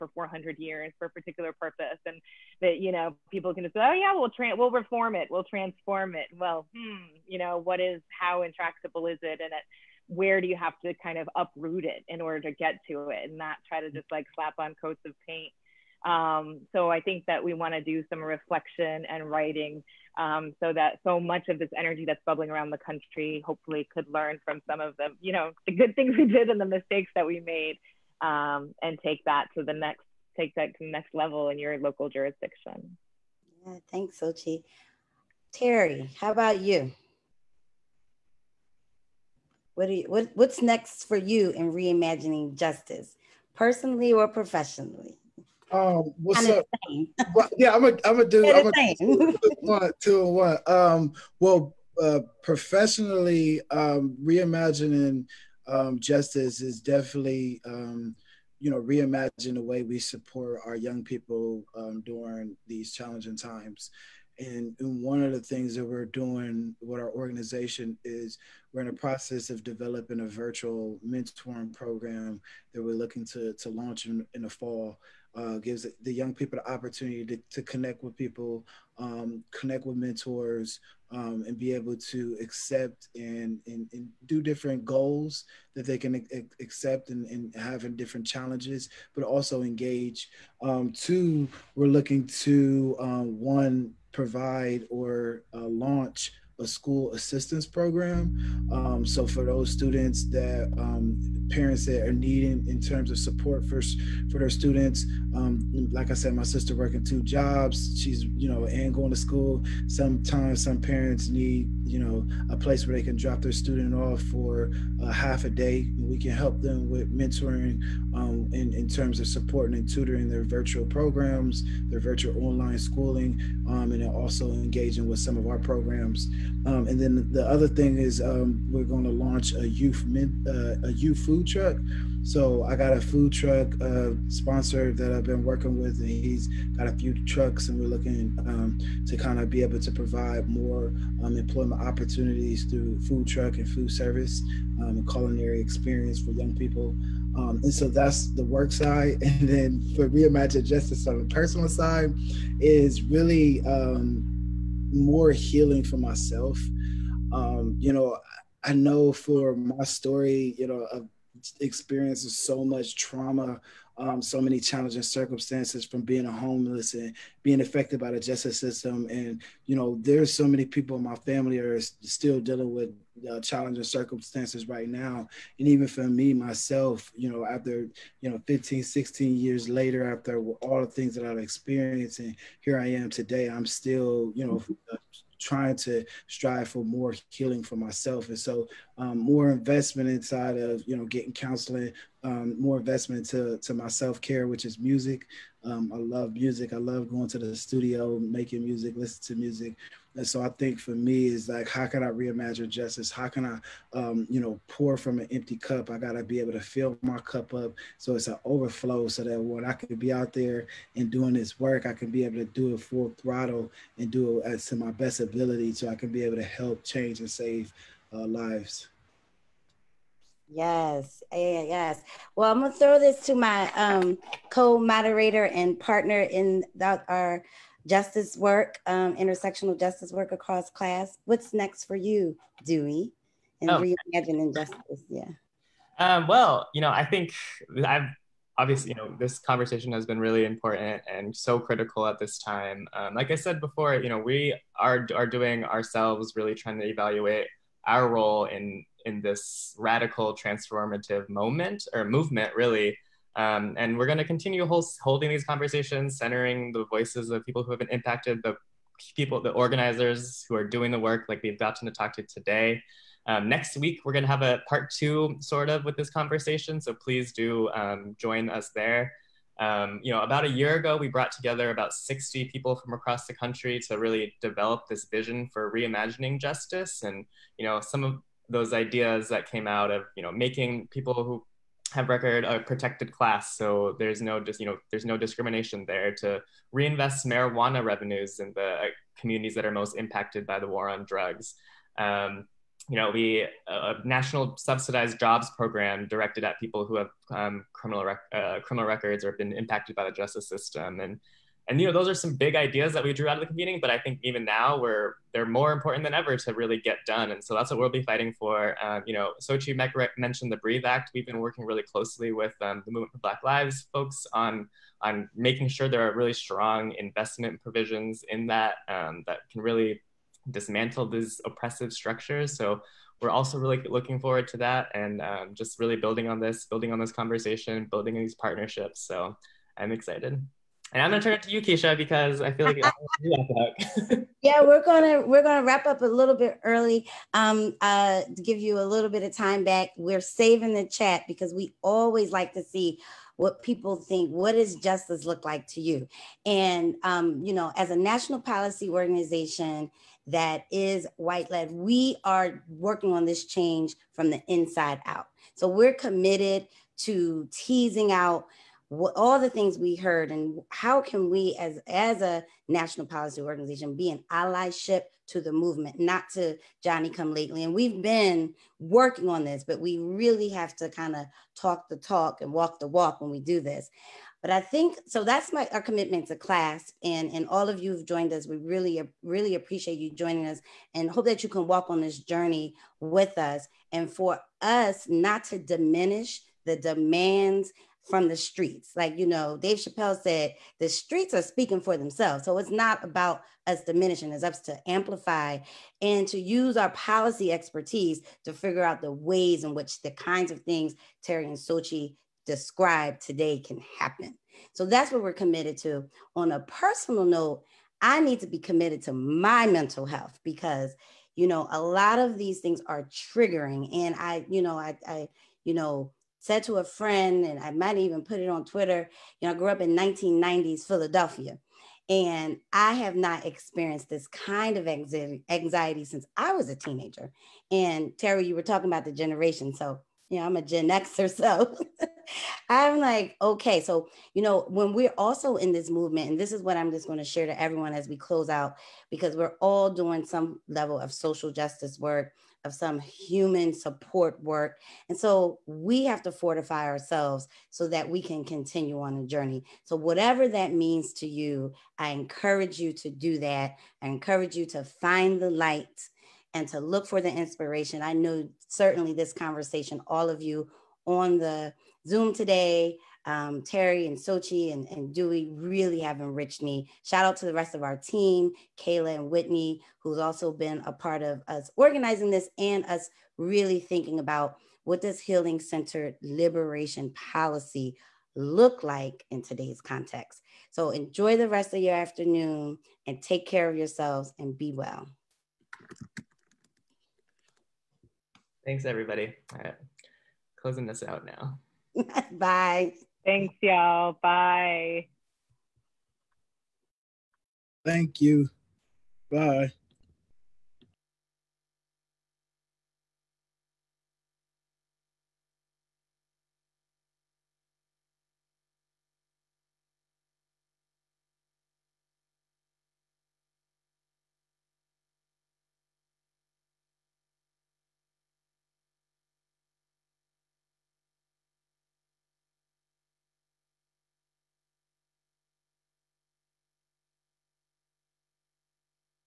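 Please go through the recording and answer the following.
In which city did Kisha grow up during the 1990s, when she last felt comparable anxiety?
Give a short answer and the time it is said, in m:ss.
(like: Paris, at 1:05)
Philadelphia, at 7:00.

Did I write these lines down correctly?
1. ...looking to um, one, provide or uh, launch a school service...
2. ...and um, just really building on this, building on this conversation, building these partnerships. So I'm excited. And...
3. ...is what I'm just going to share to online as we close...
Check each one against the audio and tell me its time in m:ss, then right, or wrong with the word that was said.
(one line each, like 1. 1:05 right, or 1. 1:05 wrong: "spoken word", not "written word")
1. 1:31 wrong: "assistance", not "service"
2. 5:24 right
3. 7:16 wrong: "everyone", not "online".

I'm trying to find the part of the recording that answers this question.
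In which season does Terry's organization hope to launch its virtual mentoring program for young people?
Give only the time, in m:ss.
1:14.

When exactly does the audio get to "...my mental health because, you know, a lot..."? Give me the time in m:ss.
6:49.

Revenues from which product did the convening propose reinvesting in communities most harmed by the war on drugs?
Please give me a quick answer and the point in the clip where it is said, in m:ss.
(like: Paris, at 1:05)
marijuana, at 4:47.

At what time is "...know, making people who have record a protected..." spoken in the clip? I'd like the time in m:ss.
4:40.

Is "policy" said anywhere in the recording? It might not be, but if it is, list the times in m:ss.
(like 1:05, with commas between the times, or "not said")
5:48, 6:03, 6:36, 7:57.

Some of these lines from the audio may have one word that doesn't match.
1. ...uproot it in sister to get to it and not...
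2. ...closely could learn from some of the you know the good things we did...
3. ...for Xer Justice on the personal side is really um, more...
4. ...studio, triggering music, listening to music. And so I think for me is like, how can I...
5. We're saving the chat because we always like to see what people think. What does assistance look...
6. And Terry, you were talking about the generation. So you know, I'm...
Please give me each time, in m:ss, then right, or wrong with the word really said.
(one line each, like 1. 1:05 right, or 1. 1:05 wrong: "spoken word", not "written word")
1. 0:11 wrong: "order", not "sister"
2. 0:23 wrong: "hopefully", not "closely"
3. 2:29 wrong: "Reimagine", not "Xer"
4. 3:17 wrong: "making", not "triggering"
5. 5:39 wrong: "justice", not "assistance"
6. 7:07 right.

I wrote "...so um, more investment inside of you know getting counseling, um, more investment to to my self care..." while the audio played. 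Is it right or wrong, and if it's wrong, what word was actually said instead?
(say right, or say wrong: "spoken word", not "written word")
right.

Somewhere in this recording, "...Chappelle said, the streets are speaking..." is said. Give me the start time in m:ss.
6:29.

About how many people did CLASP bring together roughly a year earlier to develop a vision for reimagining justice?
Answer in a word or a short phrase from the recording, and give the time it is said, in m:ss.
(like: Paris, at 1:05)
60, at 4:31.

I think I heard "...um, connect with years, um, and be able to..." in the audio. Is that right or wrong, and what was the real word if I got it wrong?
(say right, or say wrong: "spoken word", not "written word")
wrong: "mentors", not "years".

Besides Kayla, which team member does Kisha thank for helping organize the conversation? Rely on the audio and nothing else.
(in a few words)
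Whitney.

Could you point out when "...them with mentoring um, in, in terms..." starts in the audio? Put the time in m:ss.
1:56.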